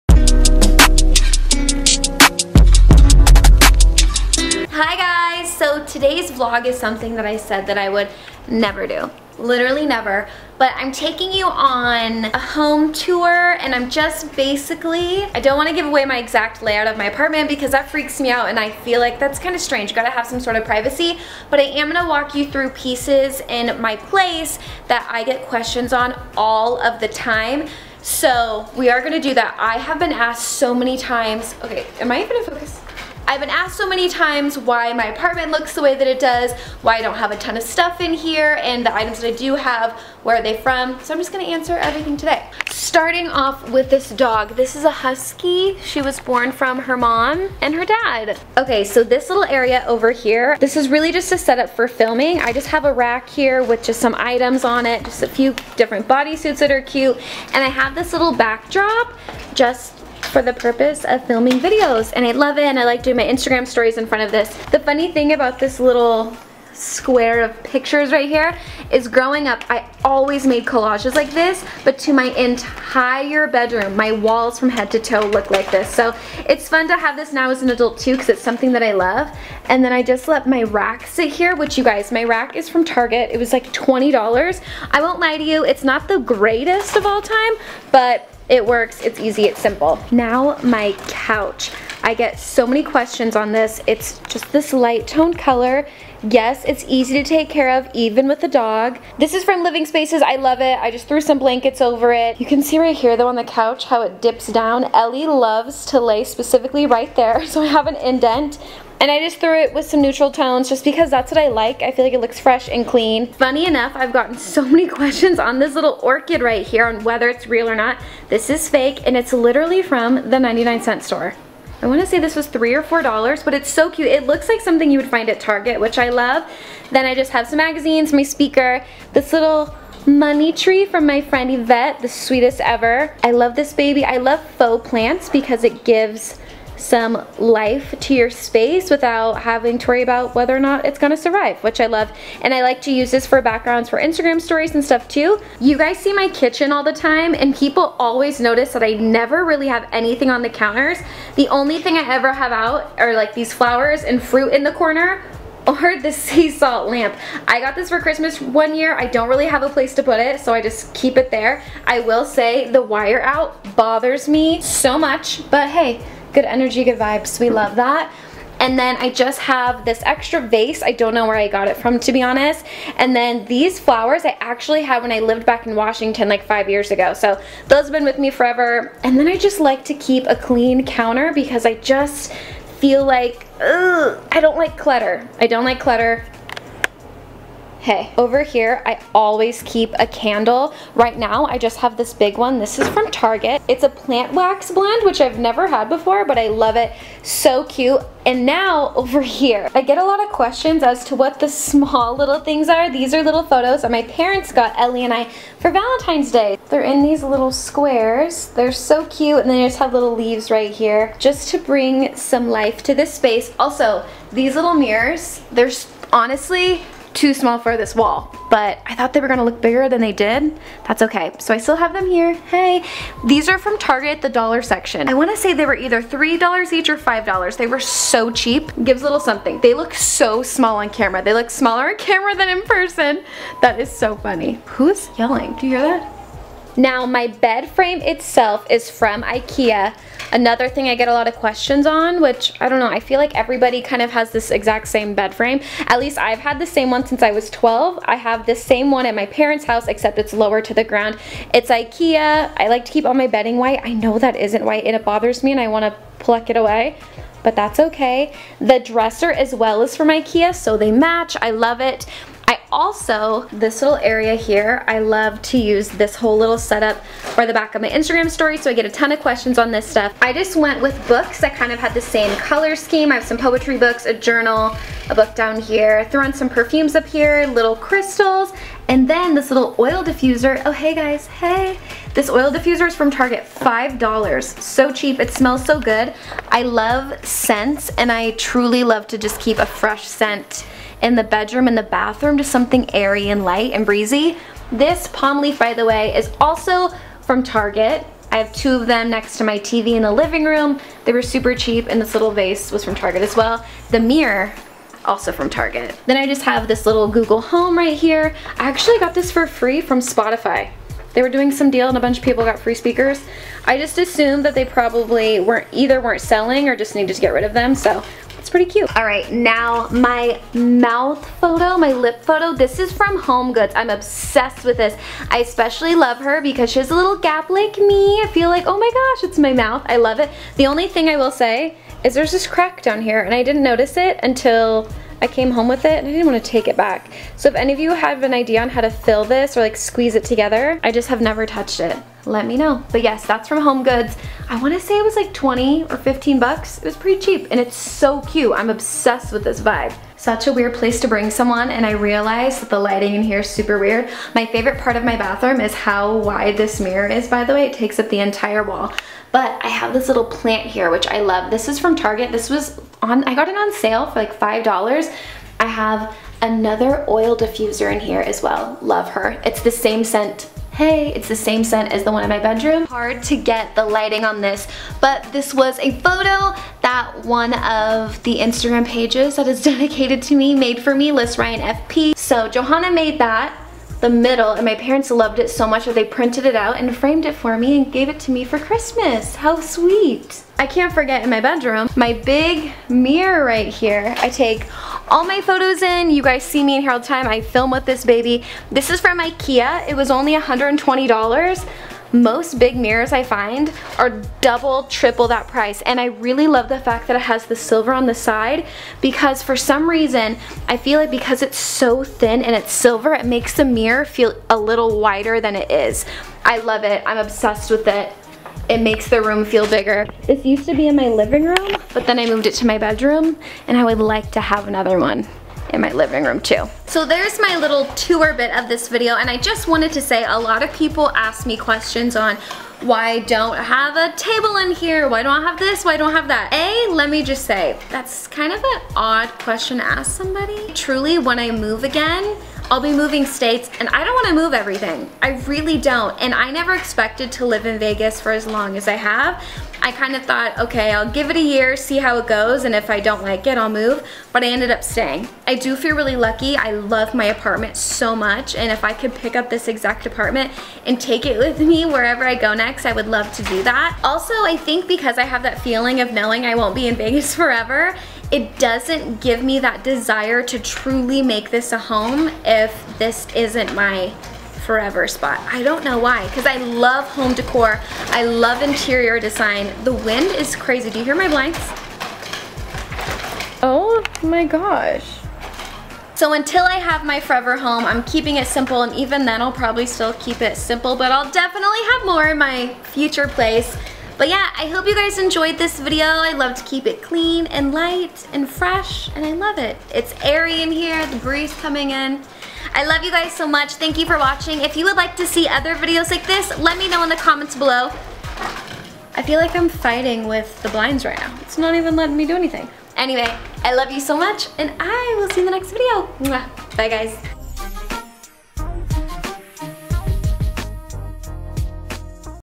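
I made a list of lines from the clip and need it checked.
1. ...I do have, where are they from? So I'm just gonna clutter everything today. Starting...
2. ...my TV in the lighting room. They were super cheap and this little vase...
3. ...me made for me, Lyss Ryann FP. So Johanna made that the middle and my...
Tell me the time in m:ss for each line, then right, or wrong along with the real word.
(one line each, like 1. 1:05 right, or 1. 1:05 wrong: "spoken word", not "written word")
1. 0:39 wrong: "answer", not "clutter"
2. 4:59 wrong: "living", not "lighting"
3. 6:20 right.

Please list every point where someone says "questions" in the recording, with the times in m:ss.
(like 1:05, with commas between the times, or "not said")
0:25, 1:32, 1:54, 3:20, 4:01, 4:29, 7:11, 7:19.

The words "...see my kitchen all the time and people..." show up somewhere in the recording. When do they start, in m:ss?
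2:25.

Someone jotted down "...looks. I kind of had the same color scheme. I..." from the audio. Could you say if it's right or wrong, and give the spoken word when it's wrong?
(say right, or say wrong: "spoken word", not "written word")
wrong: "books", not "looks".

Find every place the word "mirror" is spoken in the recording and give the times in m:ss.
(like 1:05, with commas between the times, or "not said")
3:34, 5:04, 5:56, 6:32, 6:42, 6:53.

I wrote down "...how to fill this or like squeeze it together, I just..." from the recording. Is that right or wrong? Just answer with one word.
right.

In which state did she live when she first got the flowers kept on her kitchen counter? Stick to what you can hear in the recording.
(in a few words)
Washington.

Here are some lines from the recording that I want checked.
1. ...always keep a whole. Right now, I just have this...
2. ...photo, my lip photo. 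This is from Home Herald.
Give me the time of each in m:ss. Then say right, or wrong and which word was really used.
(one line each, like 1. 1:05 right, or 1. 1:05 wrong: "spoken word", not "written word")
1. 3:09 wrong: "candle", not "whole"
2. 5:21 wrong: "Goods", not "Herald".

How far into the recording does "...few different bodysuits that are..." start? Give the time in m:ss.
0:55.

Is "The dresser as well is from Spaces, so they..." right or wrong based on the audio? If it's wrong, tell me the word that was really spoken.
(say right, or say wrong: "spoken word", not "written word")
wrong: "Ikea", not "Spaces".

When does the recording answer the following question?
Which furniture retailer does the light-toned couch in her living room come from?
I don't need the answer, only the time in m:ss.
1:39.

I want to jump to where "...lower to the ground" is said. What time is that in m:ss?
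4:10.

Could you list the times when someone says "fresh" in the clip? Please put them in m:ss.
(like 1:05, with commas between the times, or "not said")
1:52, 4:49, 8:18.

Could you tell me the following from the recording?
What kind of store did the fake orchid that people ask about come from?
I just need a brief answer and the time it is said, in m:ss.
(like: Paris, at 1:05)
99 cent store, at 2:00.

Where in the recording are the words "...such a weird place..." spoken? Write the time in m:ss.
5:50.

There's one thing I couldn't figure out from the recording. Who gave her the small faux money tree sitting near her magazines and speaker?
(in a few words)
Yvette.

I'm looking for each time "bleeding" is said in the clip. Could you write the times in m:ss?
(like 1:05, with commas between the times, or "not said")
not said.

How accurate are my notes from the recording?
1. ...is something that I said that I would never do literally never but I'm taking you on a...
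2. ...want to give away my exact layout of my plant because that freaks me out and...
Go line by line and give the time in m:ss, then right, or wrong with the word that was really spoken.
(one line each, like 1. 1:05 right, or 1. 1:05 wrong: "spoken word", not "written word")
1. 0:06 right
2. 0:15 wrong: "apartment", not "plant".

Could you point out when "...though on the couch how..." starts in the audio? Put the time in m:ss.
1:43.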